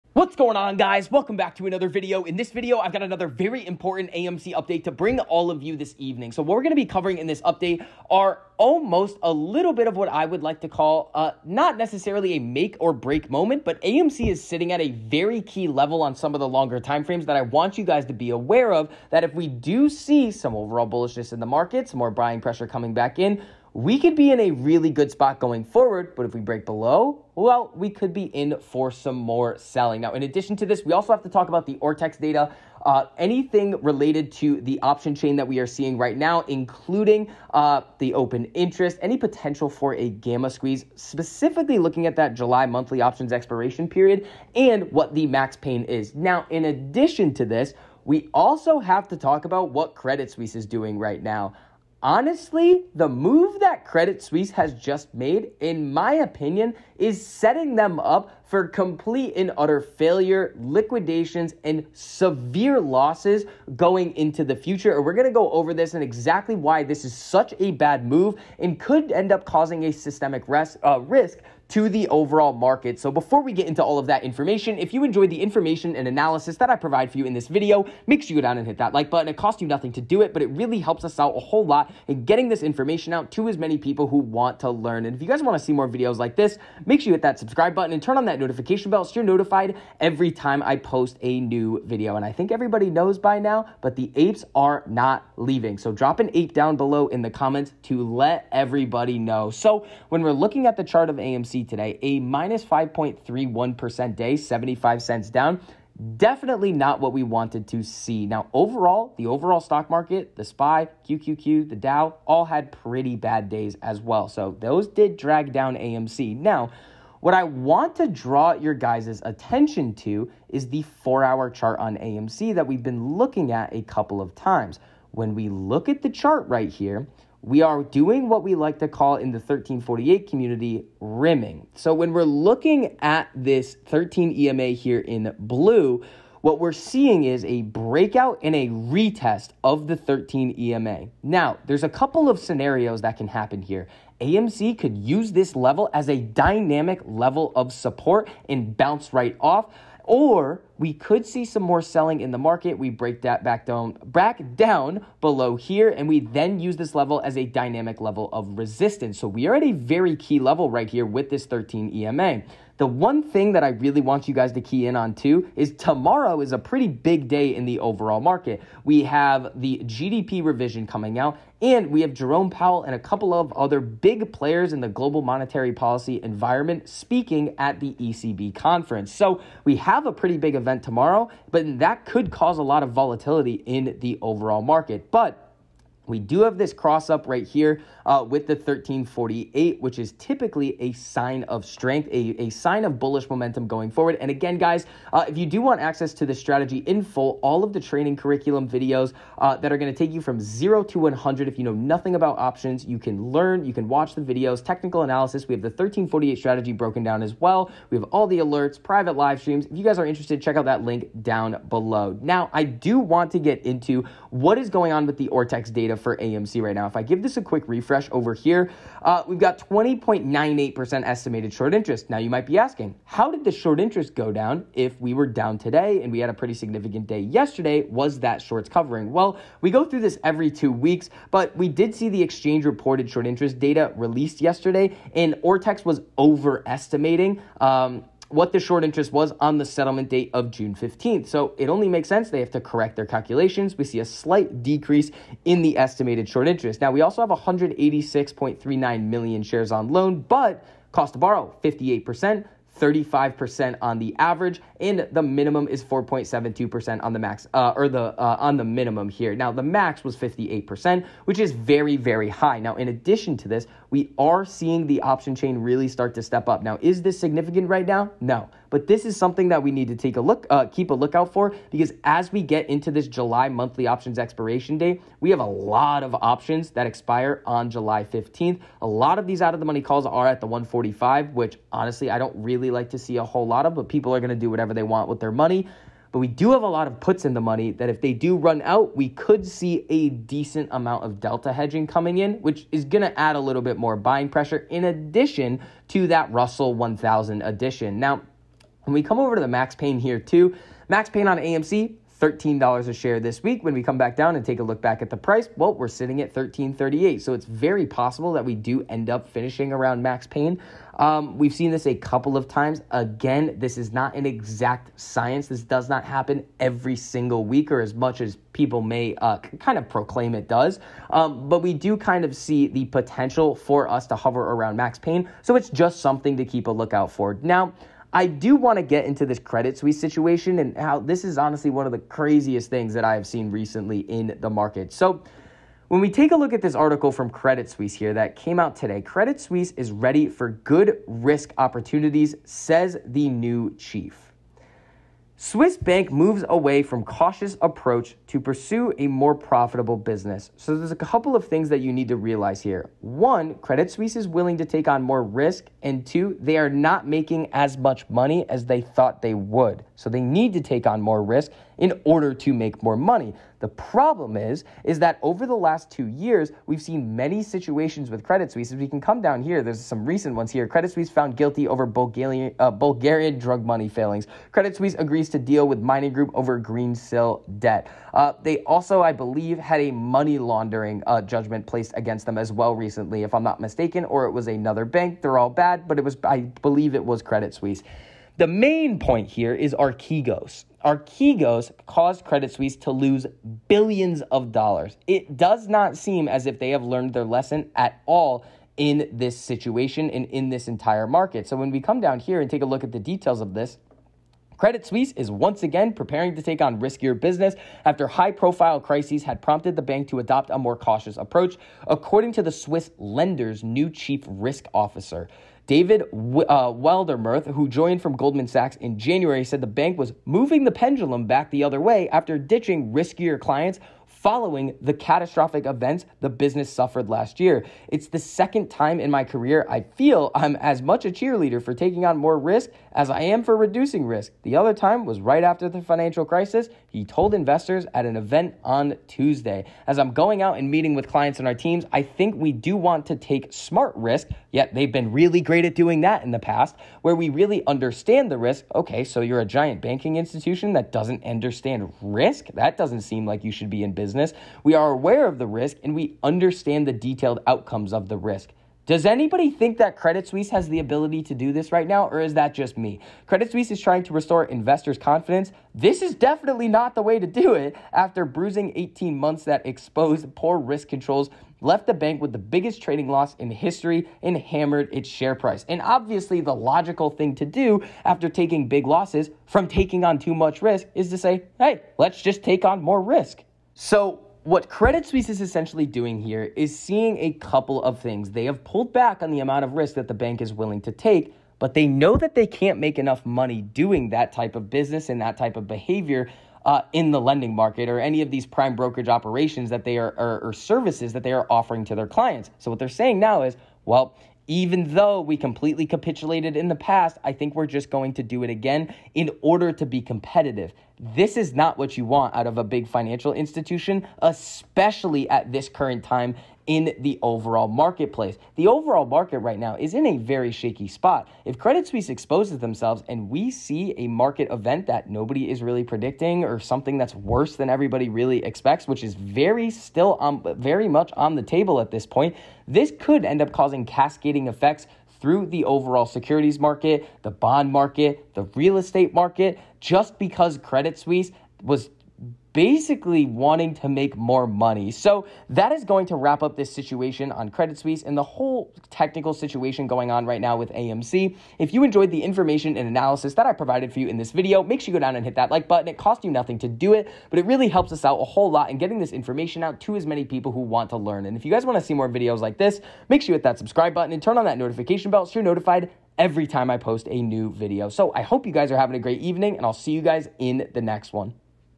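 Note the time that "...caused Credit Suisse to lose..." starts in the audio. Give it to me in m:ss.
6:31.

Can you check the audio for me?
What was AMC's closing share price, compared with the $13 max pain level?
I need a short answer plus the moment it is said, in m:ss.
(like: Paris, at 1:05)
$13.38, at 5:06.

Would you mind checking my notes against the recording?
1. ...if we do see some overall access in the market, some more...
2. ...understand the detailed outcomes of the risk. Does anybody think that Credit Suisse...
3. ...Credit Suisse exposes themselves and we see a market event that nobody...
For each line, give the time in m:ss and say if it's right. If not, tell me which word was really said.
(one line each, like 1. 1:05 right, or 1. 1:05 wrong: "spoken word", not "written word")
1. 0:19 wrong: "bullishness", not "access"
2. 7:36 right
3. 8:41 right.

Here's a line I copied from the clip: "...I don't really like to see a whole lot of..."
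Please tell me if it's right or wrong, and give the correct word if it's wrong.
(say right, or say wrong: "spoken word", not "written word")
right.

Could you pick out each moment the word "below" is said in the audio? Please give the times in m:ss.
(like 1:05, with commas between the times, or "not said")
0:26, 1:36, 2:35, 3:31.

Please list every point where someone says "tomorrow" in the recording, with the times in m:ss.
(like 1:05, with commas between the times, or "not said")
2:45, 3:00.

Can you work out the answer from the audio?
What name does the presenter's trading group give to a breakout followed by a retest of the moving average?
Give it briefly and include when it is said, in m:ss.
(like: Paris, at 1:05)
rimming, at 2:10.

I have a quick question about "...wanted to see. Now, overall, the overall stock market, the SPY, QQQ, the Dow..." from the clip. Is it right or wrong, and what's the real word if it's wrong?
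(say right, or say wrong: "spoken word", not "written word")
right.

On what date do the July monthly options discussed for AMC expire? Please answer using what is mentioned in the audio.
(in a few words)
July 15th.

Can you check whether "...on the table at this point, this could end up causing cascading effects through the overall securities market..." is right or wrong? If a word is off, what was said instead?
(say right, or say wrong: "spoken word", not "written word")
right.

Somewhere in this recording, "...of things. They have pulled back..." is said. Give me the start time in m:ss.
8:07.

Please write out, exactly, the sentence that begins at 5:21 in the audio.
Um, but we do kind of see the potential for us to hover around max pain.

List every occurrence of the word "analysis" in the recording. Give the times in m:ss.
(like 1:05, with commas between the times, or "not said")
1:16, 3:25, 9:12.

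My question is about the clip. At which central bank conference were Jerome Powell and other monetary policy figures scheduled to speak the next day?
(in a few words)
ECB conference.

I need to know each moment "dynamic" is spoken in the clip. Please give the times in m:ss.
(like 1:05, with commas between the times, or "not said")
2:26, 2:37.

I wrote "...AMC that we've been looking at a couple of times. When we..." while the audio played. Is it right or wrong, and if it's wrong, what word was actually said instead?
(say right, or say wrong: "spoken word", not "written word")
right.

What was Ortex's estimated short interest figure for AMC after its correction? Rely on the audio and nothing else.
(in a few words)
20.98%.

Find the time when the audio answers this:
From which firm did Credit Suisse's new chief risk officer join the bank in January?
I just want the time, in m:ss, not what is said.
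6:58.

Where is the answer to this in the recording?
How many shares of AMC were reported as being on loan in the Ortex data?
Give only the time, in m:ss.
4:07.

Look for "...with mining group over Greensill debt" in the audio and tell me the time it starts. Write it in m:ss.
6:15.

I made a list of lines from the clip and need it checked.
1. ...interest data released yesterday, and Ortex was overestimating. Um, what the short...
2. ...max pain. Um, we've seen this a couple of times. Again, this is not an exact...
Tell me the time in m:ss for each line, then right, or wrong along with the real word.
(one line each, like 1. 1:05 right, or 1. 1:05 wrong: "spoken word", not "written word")
1. 3:53 right
2. 5:10 right.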